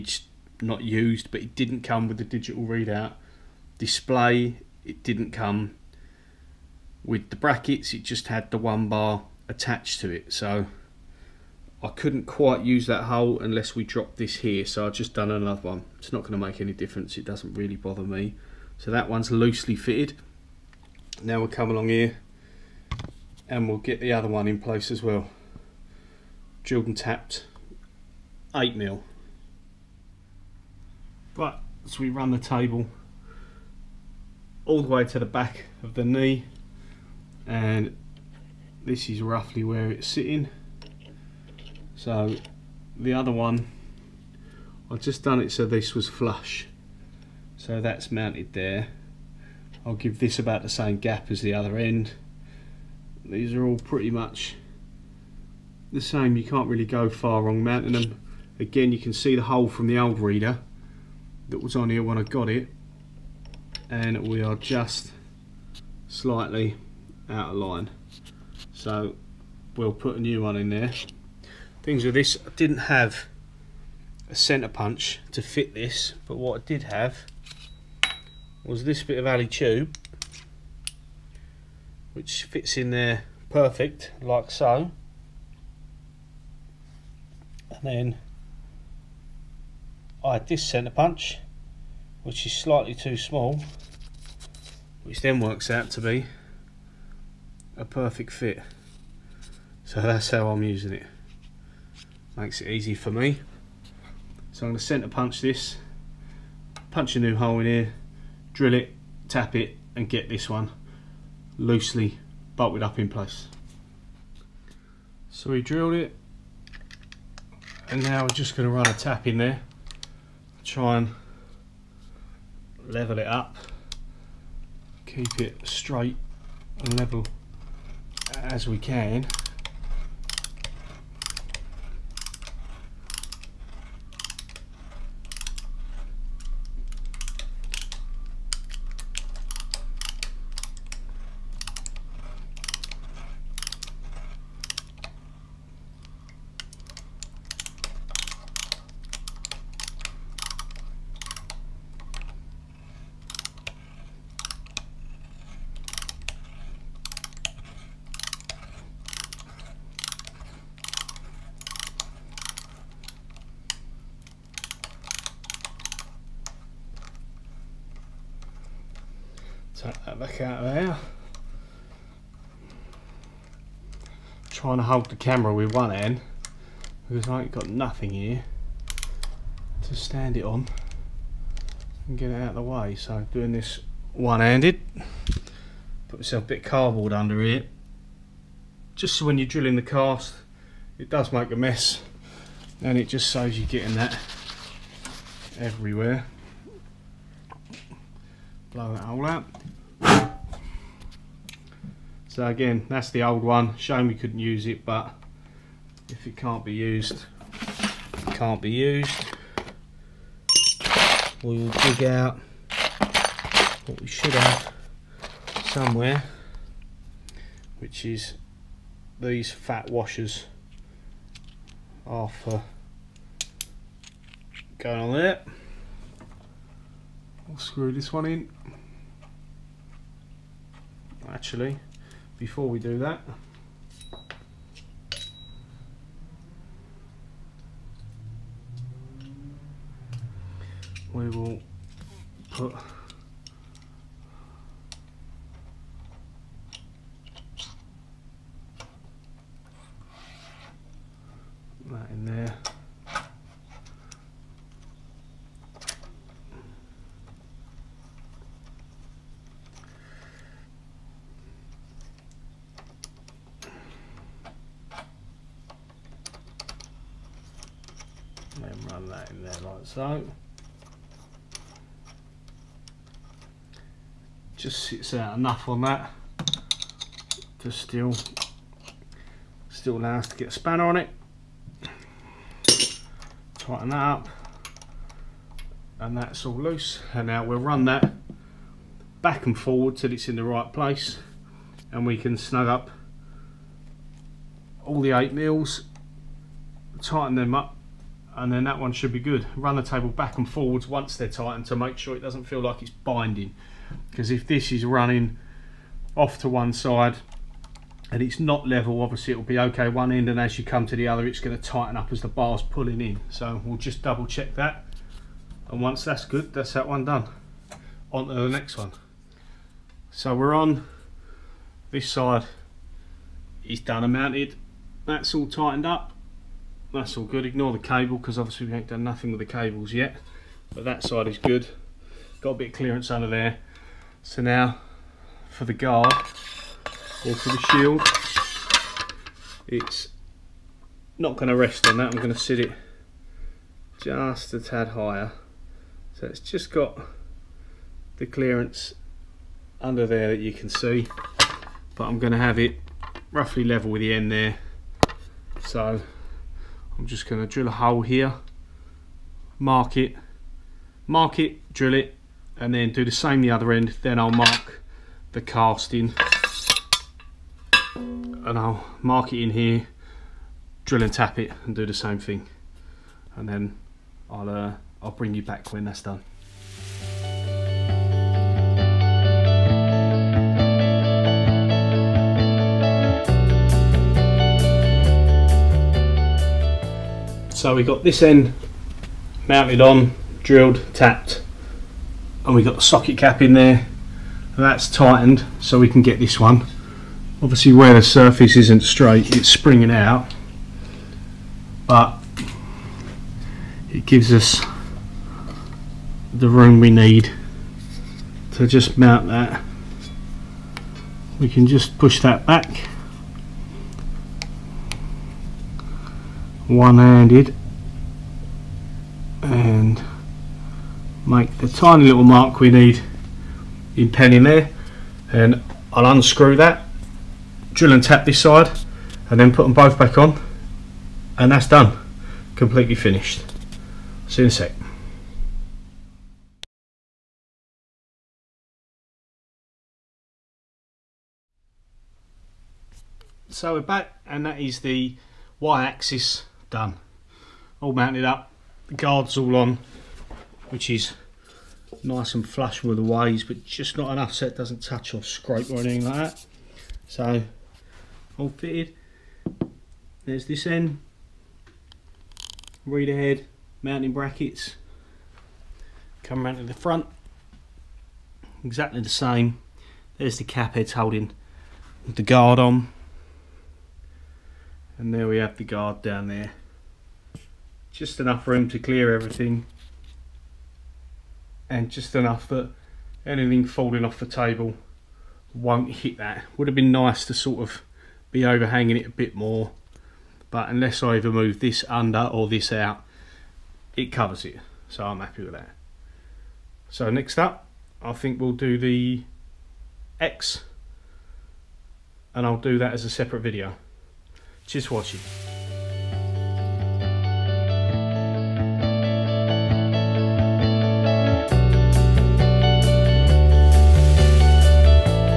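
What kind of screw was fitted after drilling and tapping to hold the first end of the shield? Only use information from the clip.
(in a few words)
socket cap.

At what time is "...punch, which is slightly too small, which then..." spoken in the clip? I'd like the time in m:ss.
1:30.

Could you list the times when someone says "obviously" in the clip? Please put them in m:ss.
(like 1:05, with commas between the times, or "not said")
5:09, 5:28, 6:37.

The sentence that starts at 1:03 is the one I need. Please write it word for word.
And we are just slightly out of line.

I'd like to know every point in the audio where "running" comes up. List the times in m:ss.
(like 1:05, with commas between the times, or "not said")
5:04.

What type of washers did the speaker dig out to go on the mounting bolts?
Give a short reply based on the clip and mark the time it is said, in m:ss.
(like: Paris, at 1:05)
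fat washers, at 3:39.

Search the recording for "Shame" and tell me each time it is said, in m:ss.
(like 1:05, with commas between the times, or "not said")
3:23.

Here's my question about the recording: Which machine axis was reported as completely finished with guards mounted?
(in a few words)
Y-axis.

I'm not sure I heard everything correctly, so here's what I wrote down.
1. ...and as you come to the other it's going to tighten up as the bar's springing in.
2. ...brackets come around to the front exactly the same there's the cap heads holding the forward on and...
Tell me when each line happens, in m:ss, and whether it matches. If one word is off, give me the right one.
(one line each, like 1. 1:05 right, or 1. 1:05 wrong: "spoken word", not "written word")
1. 5:10 wrong: "pulling", not "springing"
2. 7:44 wrong: "guard", not "forward".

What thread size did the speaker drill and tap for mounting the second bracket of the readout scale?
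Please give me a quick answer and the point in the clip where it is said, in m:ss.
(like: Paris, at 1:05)
8 mil, at 0:28.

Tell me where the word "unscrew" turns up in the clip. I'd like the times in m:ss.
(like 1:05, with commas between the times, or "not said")
7:06.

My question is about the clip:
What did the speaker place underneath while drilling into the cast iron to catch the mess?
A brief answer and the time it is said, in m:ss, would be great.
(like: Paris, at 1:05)
cardboard, at 3:06.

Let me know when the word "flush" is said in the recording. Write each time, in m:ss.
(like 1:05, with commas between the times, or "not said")
0:46, 7:32.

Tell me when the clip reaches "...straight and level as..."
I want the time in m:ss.
2:05.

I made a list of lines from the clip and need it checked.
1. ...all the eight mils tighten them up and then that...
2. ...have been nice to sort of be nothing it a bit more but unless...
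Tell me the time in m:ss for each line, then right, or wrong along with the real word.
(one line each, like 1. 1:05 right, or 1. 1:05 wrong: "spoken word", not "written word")
1. 4:54 right
2. 8:06 wrong: "overhanging", not "nothing".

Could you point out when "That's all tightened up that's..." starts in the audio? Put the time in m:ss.
5:25.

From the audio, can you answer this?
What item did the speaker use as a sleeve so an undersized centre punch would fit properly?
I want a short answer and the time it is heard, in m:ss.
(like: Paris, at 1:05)
alley tube, at 1:19.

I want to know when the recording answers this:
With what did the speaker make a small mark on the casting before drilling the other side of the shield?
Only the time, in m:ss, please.
7:04.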